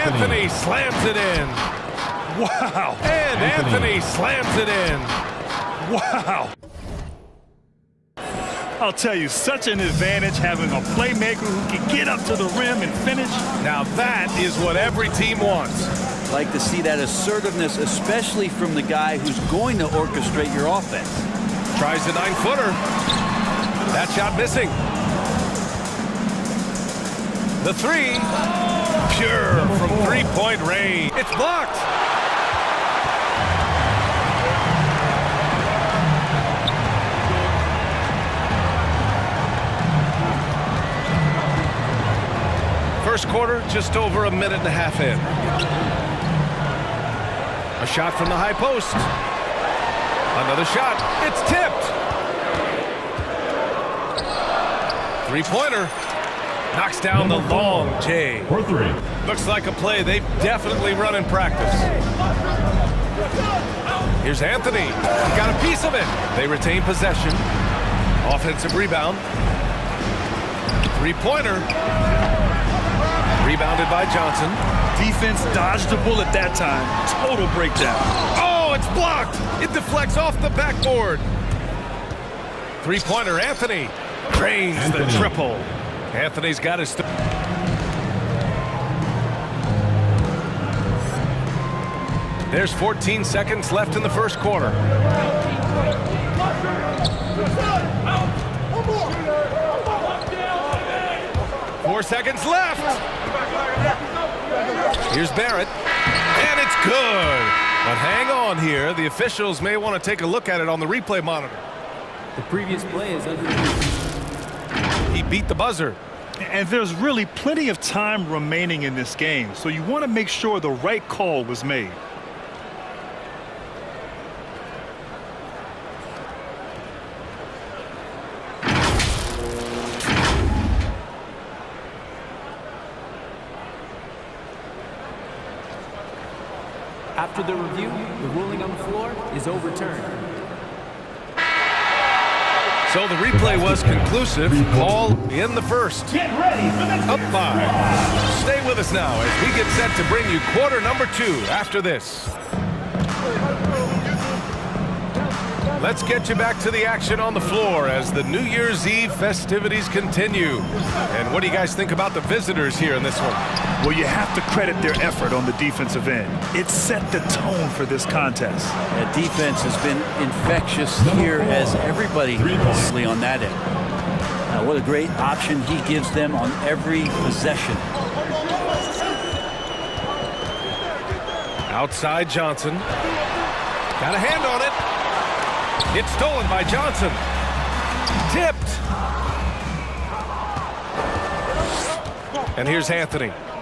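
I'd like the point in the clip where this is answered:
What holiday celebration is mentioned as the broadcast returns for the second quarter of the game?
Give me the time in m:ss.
2:38.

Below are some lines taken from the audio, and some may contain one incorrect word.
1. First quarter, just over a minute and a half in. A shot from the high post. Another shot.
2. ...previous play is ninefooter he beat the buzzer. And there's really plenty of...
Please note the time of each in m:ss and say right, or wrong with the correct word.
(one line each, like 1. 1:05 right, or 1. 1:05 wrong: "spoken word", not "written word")
1. 0:43 right
2. 1:52 wrong: "under", not "ninefooter".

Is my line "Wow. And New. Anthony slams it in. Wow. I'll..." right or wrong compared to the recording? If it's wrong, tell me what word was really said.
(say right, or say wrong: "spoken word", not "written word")
wrong: "Anthony", not "New".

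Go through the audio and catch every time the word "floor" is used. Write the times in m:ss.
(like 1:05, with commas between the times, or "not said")
2:18, 2:37.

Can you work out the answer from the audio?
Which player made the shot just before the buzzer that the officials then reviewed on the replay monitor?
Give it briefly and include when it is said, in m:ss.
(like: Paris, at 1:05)
Barrett, at 1:45.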